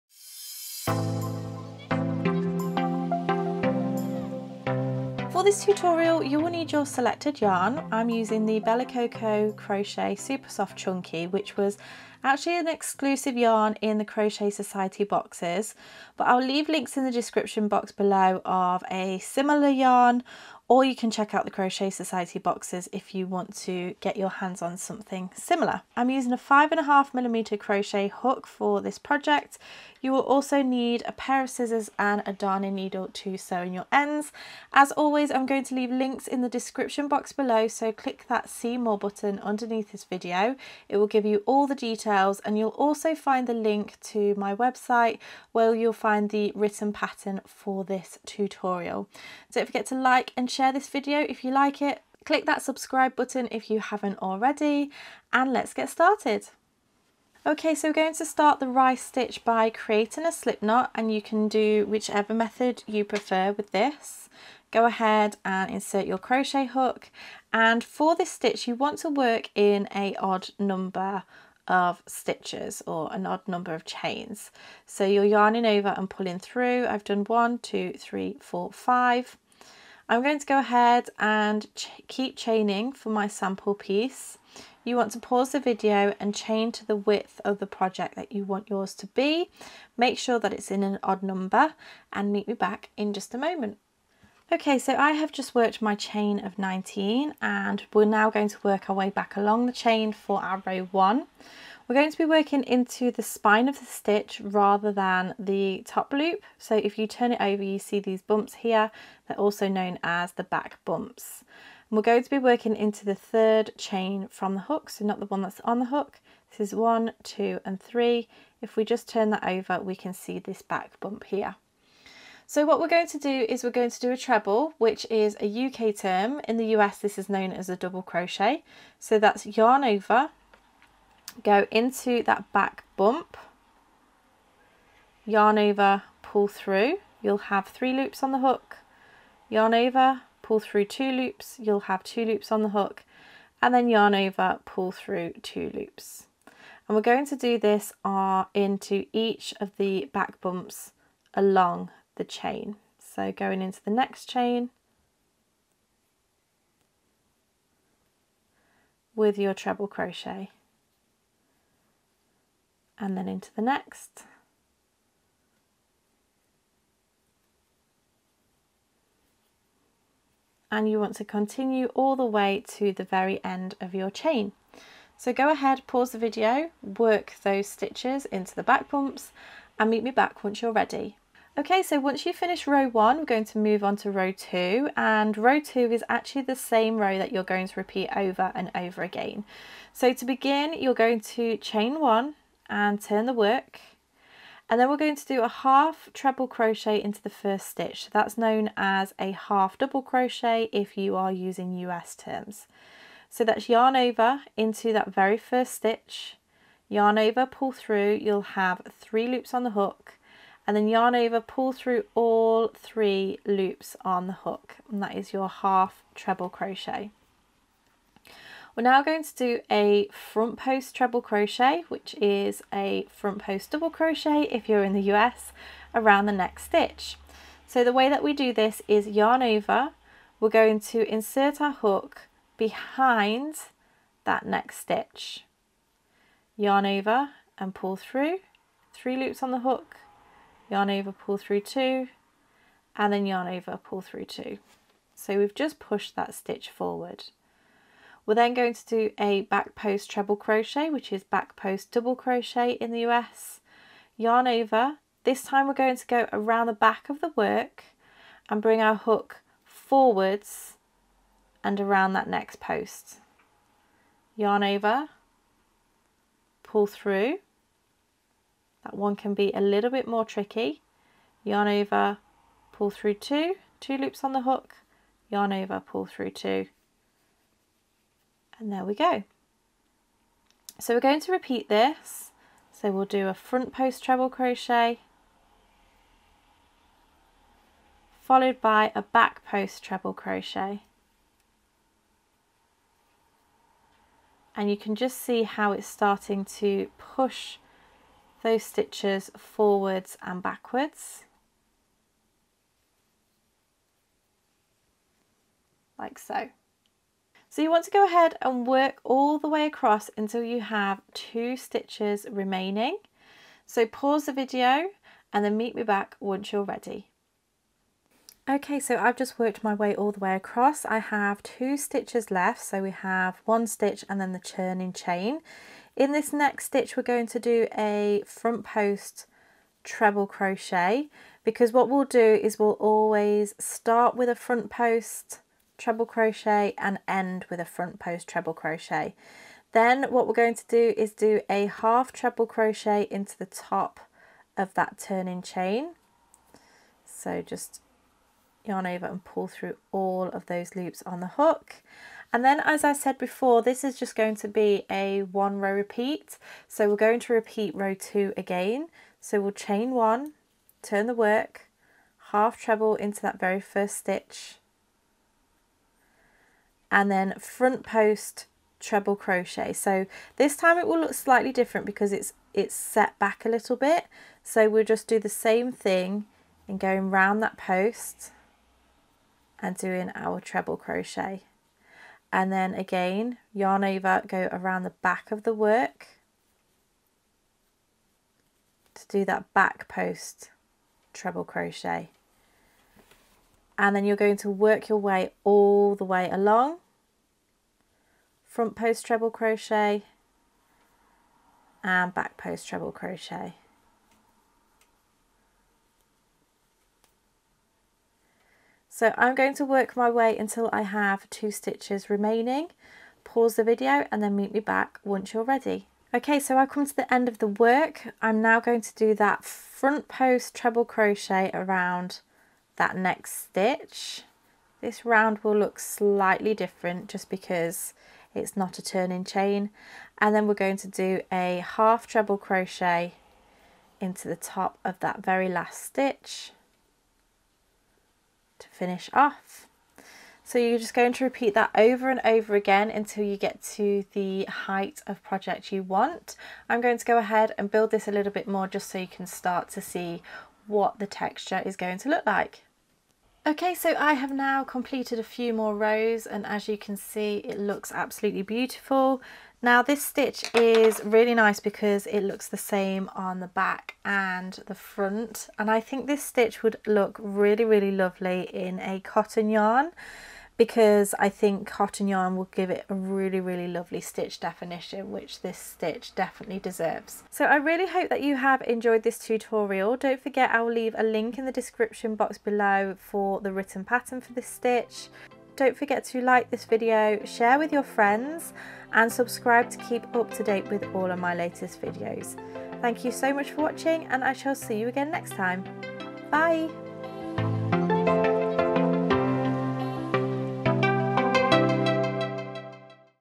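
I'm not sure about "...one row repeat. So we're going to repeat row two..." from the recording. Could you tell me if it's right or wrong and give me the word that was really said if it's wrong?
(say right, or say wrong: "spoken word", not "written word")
right.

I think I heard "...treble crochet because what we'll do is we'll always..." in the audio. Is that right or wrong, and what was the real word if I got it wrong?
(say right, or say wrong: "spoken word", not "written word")
right.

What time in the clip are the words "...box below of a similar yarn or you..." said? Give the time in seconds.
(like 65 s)
17 s.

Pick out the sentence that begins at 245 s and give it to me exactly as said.
So we've just pushed that stitch forward.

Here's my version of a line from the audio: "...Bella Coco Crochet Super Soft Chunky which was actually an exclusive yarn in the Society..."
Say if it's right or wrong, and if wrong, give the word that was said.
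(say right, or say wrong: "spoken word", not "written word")
wrong: "Crochet", not "Society".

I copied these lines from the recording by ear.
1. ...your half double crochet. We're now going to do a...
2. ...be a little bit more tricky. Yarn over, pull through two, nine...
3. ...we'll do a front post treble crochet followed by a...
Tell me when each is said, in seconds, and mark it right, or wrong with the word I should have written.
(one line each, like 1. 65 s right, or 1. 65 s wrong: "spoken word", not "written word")
1. 215 s wrong: "treble", not "double"
2. 269 s wrong: "two", not "nine"
3. 282 s right.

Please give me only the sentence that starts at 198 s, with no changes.
So that's known as a half double crochet if you are using US terms.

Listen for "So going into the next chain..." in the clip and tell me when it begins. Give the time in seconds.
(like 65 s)
152 s.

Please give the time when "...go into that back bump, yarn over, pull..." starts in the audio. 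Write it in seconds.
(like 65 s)
131 s.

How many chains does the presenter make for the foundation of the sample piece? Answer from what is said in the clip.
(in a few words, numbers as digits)
19.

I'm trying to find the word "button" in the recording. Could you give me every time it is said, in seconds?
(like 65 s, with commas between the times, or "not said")
38 s, 53 s.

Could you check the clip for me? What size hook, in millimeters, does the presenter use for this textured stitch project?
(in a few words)
5.5 mm.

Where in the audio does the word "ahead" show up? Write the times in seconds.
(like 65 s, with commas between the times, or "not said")
64 s, 80 s, 175 s, 308 s, 447 s.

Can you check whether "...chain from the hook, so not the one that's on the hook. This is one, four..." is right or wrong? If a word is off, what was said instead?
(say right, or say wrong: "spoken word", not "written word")
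wrong: "two", not "four".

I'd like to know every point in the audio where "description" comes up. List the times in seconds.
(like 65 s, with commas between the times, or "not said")
17 s, 36 s, 481 s.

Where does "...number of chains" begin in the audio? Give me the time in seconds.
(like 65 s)
73 s.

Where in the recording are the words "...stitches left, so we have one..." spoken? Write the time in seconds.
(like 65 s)
321 s.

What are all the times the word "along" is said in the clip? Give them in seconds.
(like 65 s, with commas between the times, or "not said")
99 s, 151 s, 396 s.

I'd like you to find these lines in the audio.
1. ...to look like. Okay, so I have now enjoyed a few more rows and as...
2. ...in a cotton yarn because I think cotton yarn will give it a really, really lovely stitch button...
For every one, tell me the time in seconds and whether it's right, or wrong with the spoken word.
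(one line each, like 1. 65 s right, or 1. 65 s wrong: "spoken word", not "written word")
1. 451 s wrong: "completed", not "enjoyed"
2. 468 s wrong: "definition", not "button".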